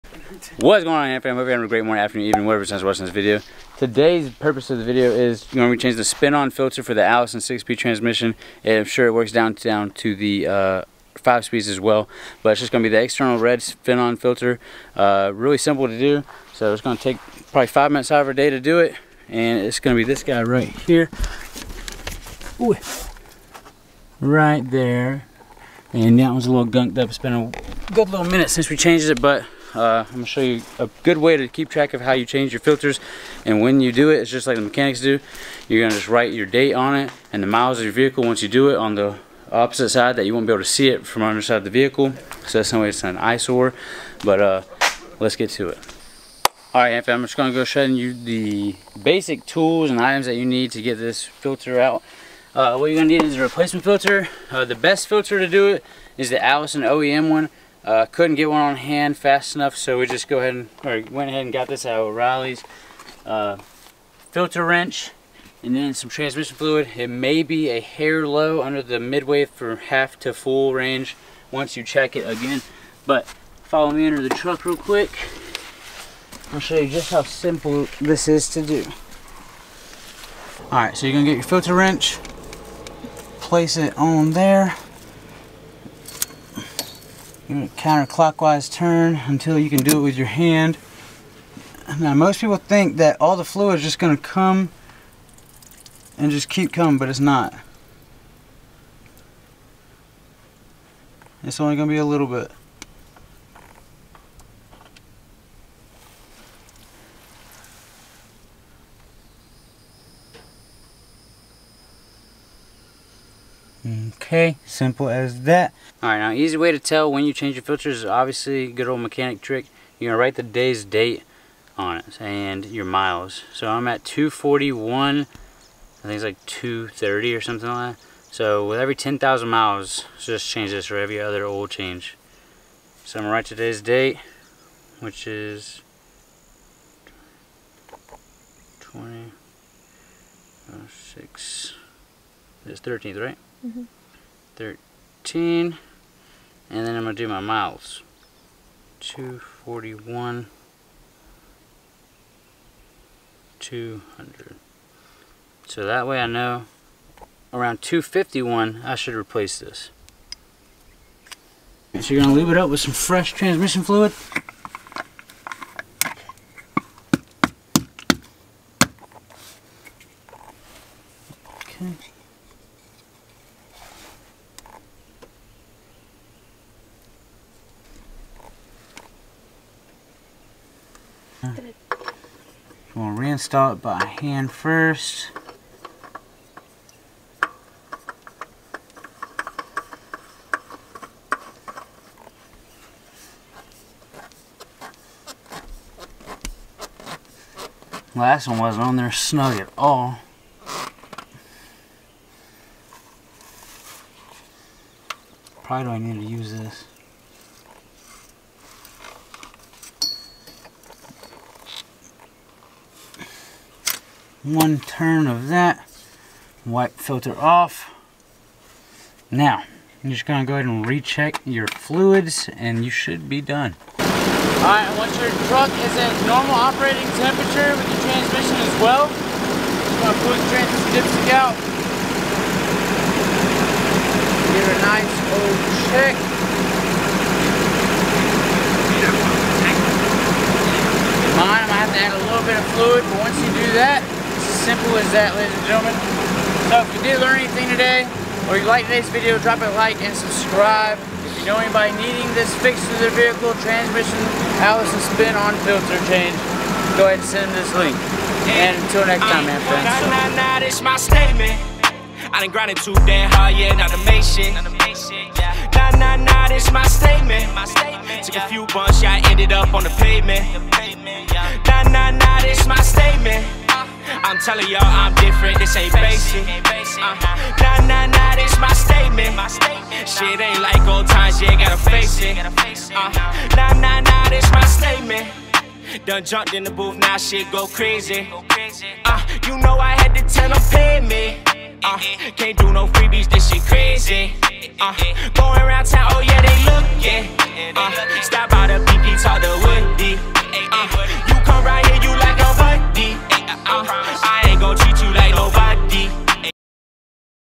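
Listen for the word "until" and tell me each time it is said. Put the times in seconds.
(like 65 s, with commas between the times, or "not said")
89 s, 258 s.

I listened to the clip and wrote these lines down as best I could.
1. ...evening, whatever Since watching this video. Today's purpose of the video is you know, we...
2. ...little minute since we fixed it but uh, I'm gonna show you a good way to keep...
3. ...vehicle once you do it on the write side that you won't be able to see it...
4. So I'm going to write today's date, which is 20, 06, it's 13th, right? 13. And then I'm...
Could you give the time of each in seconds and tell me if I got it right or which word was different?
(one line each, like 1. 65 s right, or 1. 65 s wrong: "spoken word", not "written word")
1. 2 s right
2. 28 s wrong: "changed", not "fixed"
3. 37 s wrong: "opposite", not "write"
4. 133 s right.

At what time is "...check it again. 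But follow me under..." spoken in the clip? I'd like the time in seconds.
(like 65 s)
71 s.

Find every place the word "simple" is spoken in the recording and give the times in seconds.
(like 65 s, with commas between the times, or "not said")
15 s, 77 s, 114 s, 244 s.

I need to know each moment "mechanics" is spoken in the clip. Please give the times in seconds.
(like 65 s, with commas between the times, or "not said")
34 s, 119 s.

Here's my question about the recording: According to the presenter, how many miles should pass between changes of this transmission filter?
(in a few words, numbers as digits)
10,000 miles.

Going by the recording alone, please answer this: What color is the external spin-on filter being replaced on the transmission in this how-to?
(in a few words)
Red.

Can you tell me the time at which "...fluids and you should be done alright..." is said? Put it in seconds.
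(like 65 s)
221 s.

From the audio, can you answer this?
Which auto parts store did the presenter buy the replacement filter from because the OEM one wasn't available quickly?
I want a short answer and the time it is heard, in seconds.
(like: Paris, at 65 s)
O'Reilly's, at 62 s.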